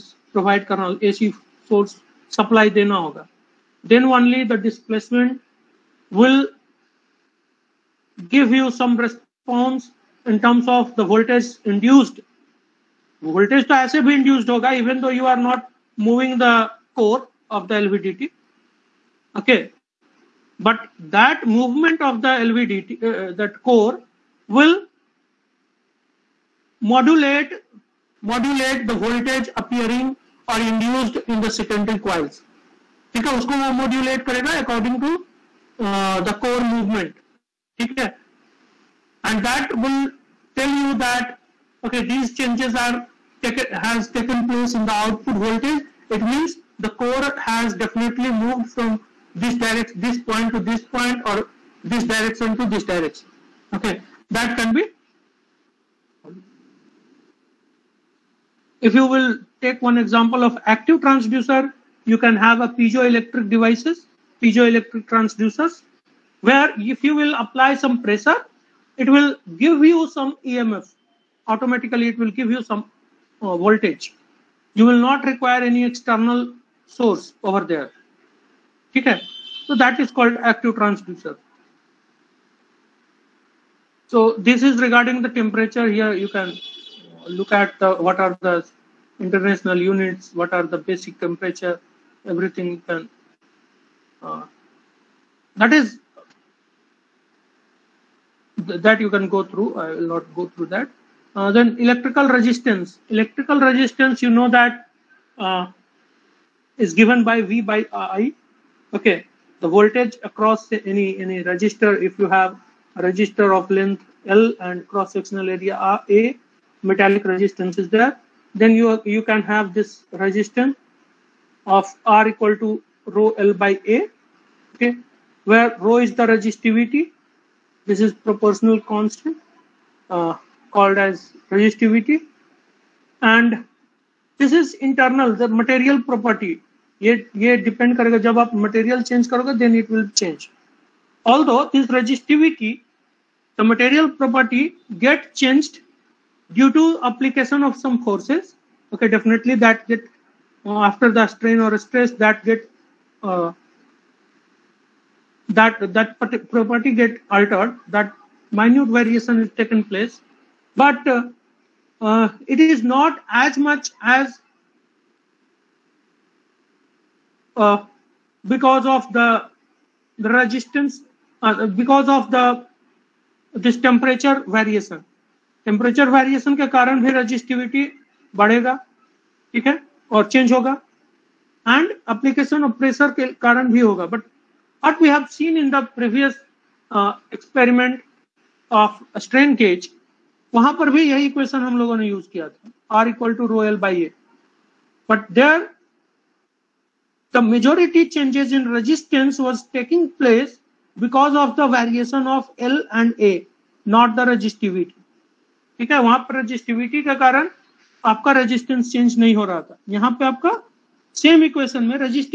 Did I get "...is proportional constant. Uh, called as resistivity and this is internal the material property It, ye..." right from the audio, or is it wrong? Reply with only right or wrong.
right.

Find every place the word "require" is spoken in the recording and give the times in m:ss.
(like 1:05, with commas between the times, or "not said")
1:15.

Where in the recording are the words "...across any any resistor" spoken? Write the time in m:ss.
1:50.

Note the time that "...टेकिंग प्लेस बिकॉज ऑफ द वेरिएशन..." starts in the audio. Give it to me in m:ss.
3:19.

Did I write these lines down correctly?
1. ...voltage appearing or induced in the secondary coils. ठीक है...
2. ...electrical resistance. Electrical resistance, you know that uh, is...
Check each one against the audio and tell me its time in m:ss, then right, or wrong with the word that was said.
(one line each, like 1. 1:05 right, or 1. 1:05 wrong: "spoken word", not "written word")
1. 0:29 right
2. 1:41 right.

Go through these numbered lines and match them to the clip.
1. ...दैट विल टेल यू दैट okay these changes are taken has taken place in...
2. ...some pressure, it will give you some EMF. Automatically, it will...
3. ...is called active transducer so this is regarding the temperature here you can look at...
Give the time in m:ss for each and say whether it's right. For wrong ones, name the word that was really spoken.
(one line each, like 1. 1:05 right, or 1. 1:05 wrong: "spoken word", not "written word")
1. 0:39 right
2. 1:07 right
3. 1:20 right.